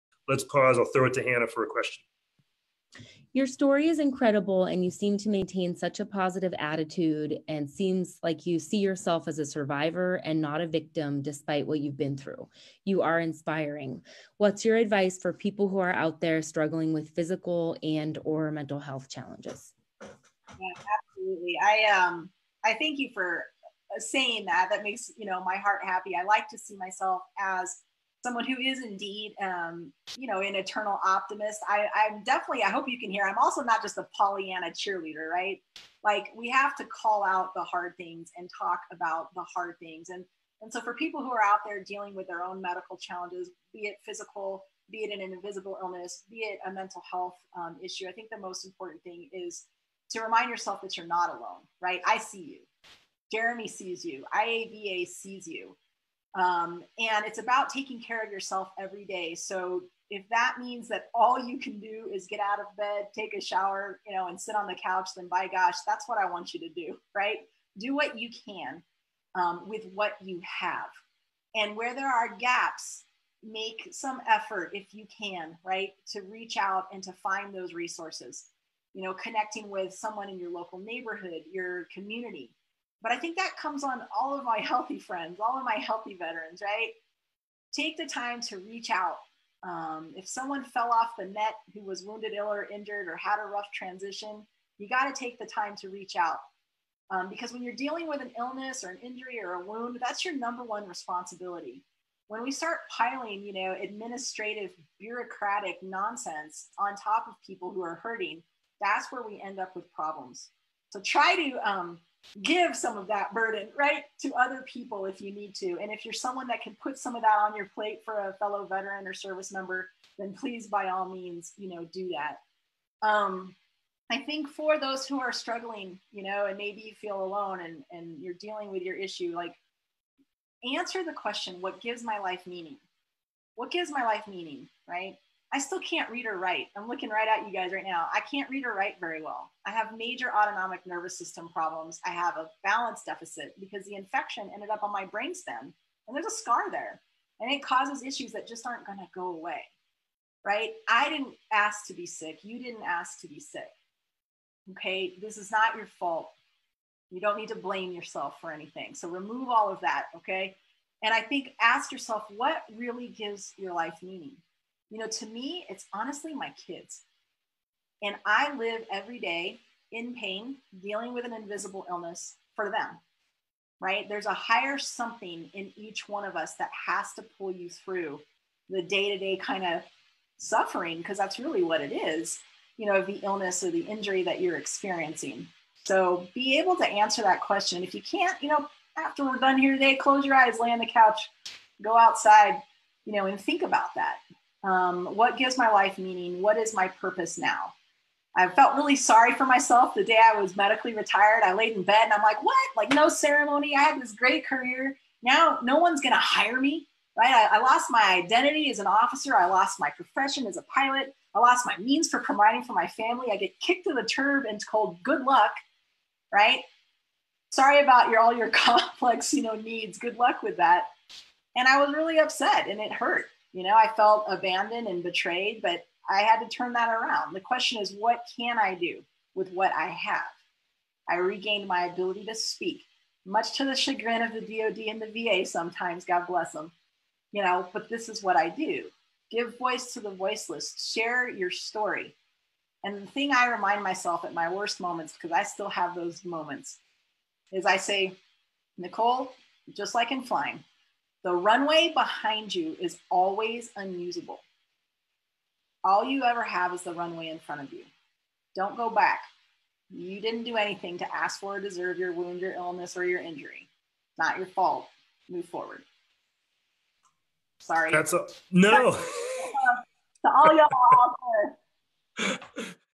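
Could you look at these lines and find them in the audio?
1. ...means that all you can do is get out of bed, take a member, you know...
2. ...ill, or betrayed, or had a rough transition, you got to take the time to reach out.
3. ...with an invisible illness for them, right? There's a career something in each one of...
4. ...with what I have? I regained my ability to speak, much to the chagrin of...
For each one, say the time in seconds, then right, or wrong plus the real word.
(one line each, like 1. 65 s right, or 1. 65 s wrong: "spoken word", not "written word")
1. 60 s wrong: "shower", not "member"
2. 92 s wrong: "injured", not "betrayed"
3. 171 s wrong: "higher", not "career"
4. 229 s right.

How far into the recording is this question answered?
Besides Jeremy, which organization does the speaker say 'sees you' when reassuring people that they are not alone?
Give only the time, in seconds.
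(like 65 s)
54 s.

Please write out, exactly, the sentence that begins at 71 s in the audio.
And where there are gaps, make some effort if you can, right, to reach out and to find those resources.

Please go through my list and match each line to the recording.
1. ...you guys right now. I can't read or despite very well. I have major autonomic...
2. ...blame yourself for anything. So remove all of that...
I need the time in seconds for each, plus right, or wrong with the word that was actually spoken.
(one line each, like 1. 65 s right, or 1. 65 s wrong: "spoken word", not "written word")
1. 137 s wrong: "write", not "despite"
2. 157 s right.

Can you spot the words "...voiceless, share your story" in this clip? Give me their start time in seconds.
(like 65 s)
240 s.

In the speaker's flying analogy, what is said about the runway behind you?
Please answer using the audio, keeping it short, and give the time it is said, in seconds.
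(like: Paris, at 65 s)
Always unusable, at 253 s.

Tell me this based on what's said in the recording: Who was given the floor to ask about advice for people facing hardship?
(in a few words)
Hannah.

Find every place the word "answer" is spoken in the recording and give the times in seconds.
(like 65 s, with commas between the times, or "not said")
130 s, 186 s.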